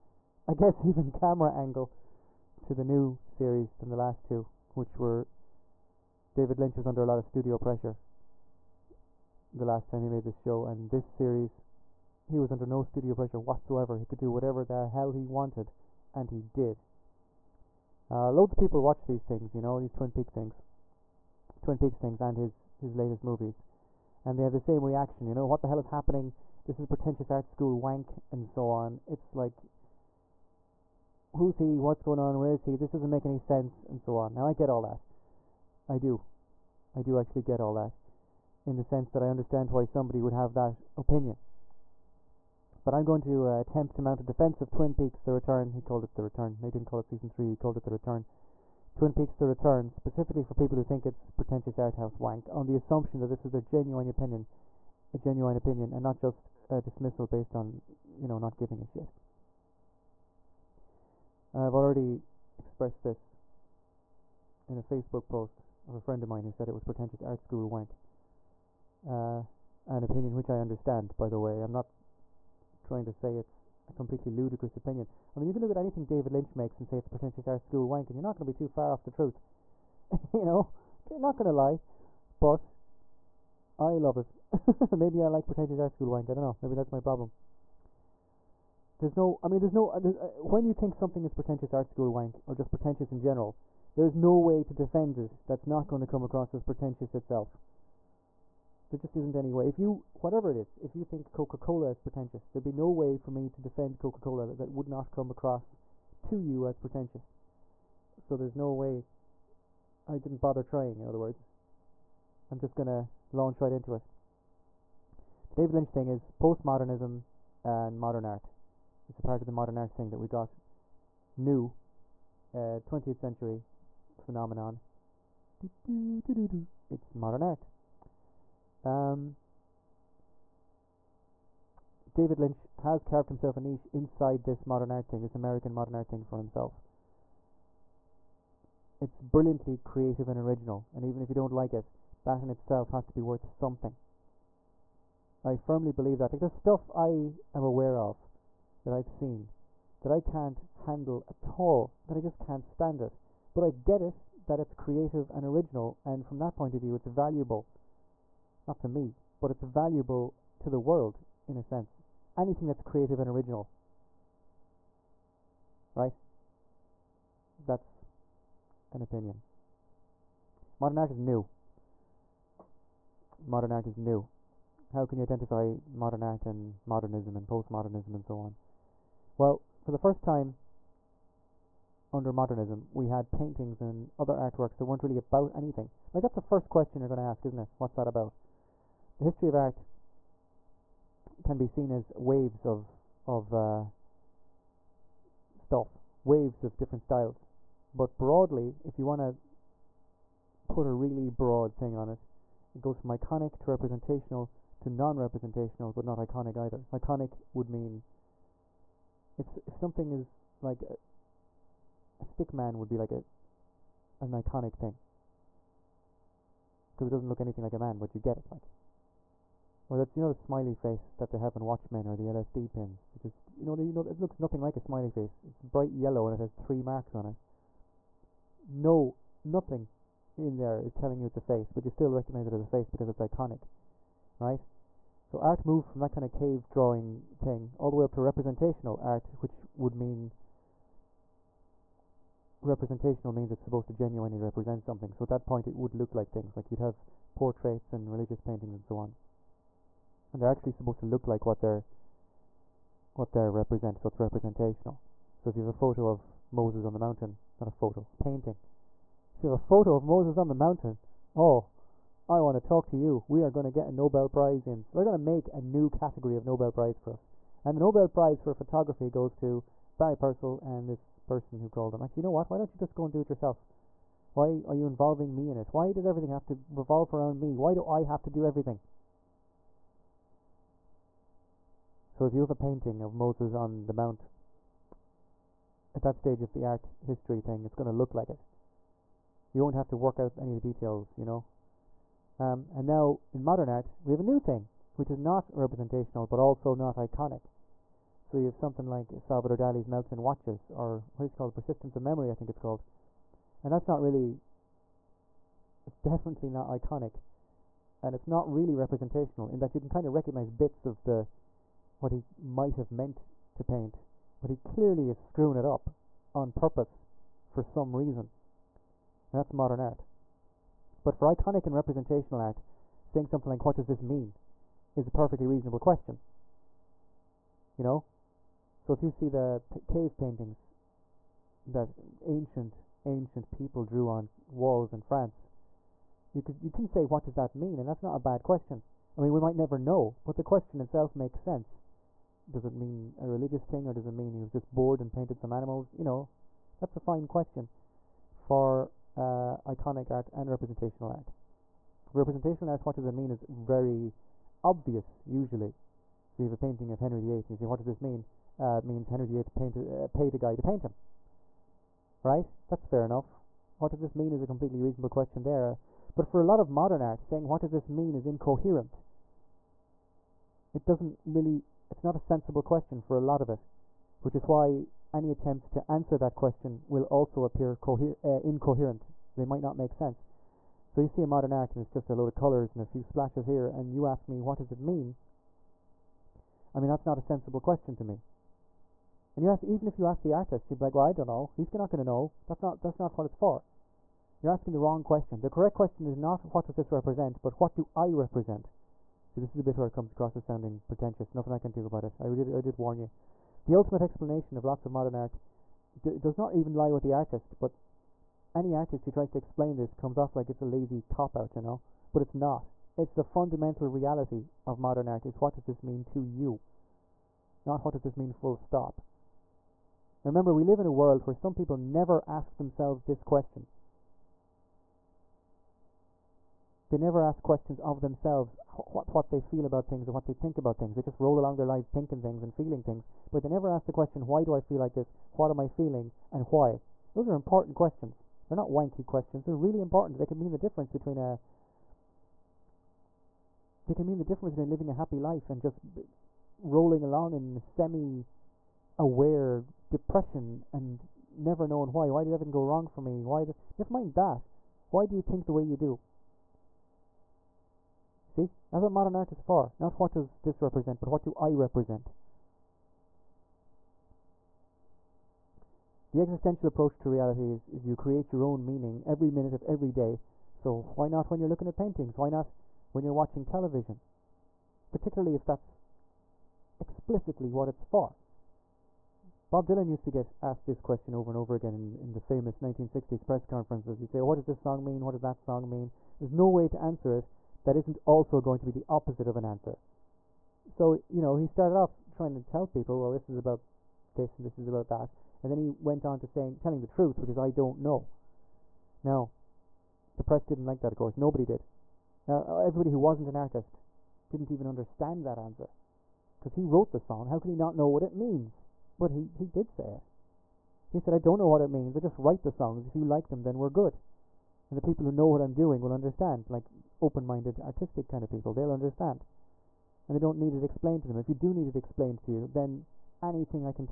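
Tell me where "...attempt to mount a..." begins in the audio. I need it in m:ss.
0:43.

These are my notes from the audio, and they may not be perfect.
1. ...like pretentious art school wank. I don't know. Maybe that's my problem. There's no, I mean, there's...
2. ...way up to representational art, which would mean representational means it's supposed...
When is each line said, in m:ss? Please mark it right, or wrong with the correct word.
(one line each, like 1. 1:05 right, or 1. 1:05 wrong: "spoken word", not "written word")
1. 1:25 right
2. 3:57 right.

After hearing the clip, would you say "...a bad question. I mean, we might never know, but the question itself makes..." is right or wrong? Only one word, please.
right.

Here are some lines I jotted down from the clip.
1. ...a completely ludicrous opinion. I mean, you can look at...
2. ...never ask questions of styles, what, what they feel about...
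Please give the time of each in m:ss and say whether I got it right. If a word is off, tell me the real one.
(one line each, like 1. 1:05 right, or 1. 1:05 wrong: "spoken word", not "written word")
1. 1:13 right
2. 7:06 wrong: "themselves", not "styles".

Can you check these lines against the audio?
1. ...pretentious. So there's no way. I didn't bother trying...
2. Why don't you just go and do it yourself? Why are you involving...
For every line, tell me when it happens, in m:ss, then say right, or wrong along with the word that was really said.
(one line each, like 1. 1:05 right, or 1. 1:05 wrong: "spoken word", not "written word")
1. 1:46 right
2. 4:32 right.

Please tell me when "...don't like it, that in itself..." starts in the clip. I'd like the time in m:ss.
2:21.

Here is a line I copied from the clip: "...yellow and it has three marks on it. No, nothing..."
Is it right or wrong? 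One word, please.
right.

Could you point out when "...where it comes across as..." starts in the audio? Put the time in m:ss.
6:39.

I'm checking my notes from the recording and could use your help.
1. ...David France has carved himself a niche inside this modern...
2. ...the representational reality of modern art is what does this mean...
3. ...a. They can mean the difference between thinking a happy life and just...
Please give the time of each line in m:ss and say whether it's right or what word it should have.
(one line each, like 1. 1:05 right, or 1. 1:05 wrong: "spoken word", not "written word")
1. 2:12 wrong: "Lynch", not "France"
2. 6:53 wrong: "fundamental", not "representational"
3. 7:21 wrong: "living", not "thinking".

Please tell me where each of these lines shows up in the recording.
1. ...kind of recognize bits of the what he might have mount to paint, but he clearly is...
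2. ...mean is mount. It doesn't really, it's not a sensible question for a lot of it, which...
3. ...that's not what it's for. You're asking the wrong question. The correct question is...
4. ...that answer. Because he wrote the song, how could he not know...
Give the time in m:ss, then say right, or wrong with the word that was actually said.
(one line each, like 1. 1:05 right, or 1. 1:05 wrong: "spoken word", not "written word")
1. 5:09 wrong: "meant", not "mount"
2. 6:07 wrong: "incoherent", not "mount"
3. 6:32 right
4. 8:25 right.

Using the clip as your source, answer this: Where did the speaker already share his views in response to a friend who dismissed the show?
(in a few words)
Facebook post.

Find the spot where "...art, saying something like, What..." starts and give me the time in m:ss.
5:22.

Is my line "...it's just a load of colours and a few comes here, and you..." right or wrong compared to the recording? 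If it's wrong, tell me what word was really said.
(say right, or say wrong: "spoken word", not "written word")
wrong: "splashes", not "comes".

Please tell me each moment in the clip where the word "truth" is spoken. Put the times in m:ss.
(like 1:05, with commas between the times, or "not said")
1:19, 8:16.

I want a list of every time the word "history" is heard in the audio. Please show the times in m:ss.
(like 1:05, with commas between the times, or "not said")
3:09, 4:46.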